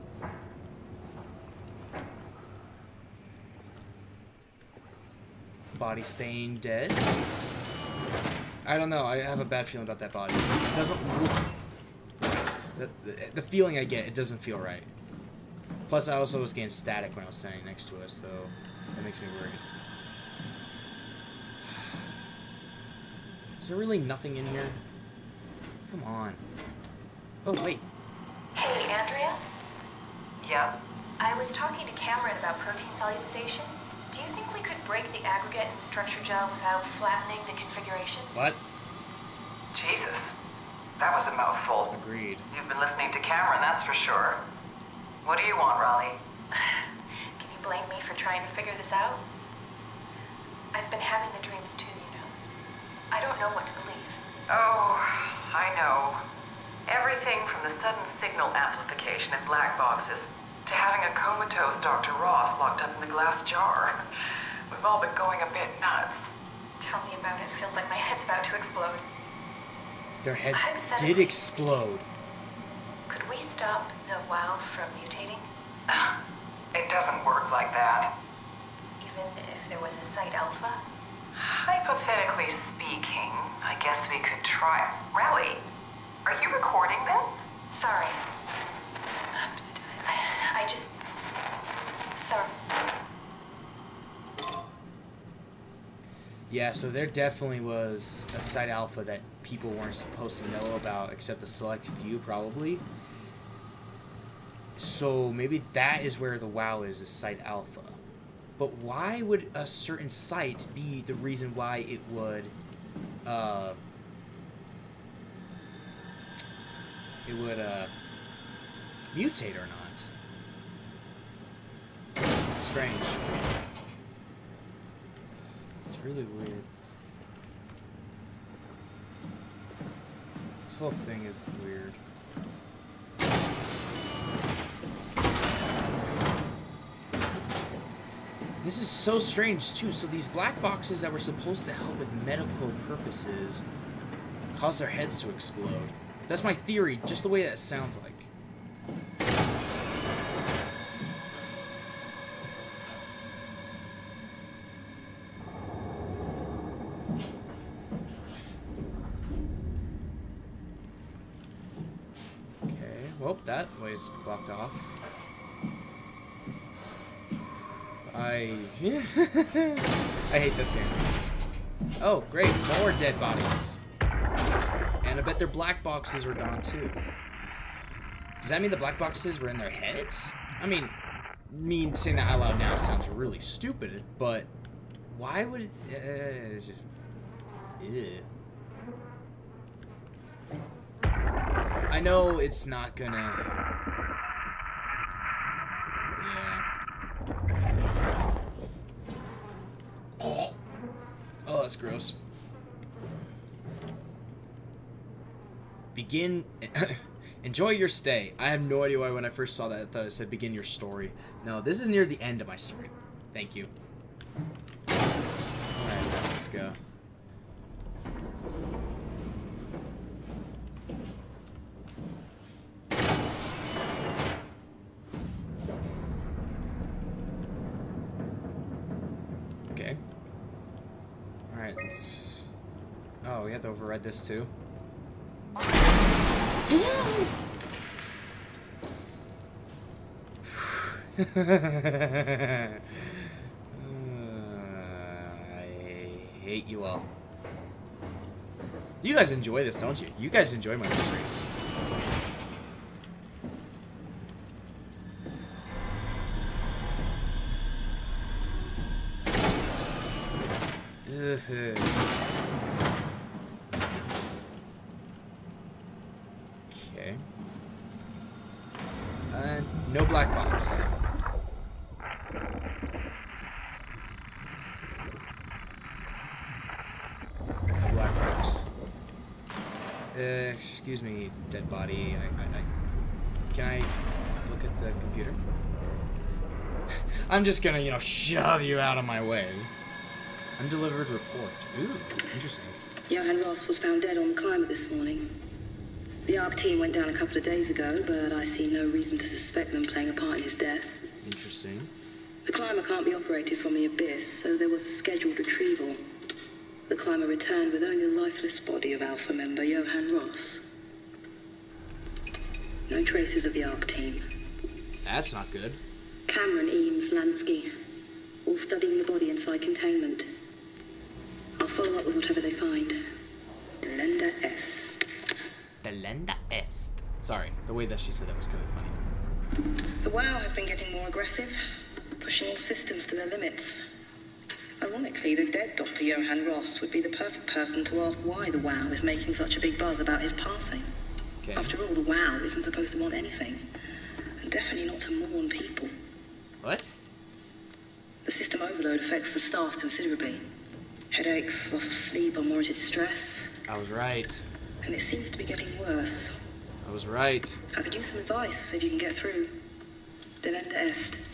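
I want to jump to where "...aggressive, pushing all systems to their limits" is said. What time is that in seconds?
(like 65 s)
331 s.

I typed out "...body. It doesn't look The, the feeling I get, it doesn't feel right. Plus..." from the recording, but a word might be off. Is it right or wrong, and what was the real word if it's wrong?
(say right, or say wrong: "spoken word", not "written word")
right.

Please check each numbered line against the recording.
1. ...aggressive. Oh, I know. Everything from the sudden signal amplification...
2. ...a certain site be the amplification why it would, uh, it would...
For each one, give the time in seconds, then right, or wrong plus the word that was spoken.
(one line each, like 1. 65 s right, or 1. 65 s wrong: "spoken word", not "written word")
1. 53 s wrong: "believe", not "aggressive"
2. 109 s wrong: "reason", not "amplification".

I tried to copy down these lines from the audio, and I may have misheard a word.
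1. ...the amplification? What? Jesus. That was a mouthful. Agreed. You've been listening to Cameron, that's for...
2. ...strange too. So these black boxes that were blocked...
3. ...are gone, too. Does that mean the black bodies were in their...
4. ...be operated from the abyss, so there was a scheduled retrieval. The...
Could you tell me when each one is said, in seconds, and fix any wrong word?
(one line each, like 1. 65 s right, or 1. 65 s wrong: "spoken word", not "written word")
1. 37 s wrong: "configuration", not "amplification"
2. 139 s wrong: "supposed", not "blocked"
3. 176 s wrong: "boxes", not "bodies"
4. 303 s right.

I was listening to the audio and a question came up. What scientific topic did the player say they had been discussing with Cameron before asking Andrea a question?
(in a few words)
protein solubilization.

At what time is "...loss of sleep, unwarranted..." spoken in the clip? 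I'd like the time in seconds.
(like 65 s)
351 s.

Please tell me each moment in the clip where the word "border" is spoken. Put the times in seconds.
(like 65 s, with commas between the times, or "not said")
not said.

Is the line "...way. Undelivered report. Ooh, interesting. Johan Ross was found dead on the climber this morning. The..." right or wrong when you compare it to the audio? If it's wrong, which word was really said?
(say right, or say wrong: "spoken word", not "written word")
right.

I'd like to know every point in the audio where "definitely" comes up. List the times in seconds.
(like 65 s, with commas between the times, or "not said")
97 s, 344 s.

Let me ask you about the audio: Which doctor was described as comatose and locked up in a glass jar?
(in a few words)
Dr. Ross.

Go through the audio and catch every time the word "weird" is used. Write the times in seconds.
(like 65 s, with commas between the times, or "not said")
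126 s, 131 s.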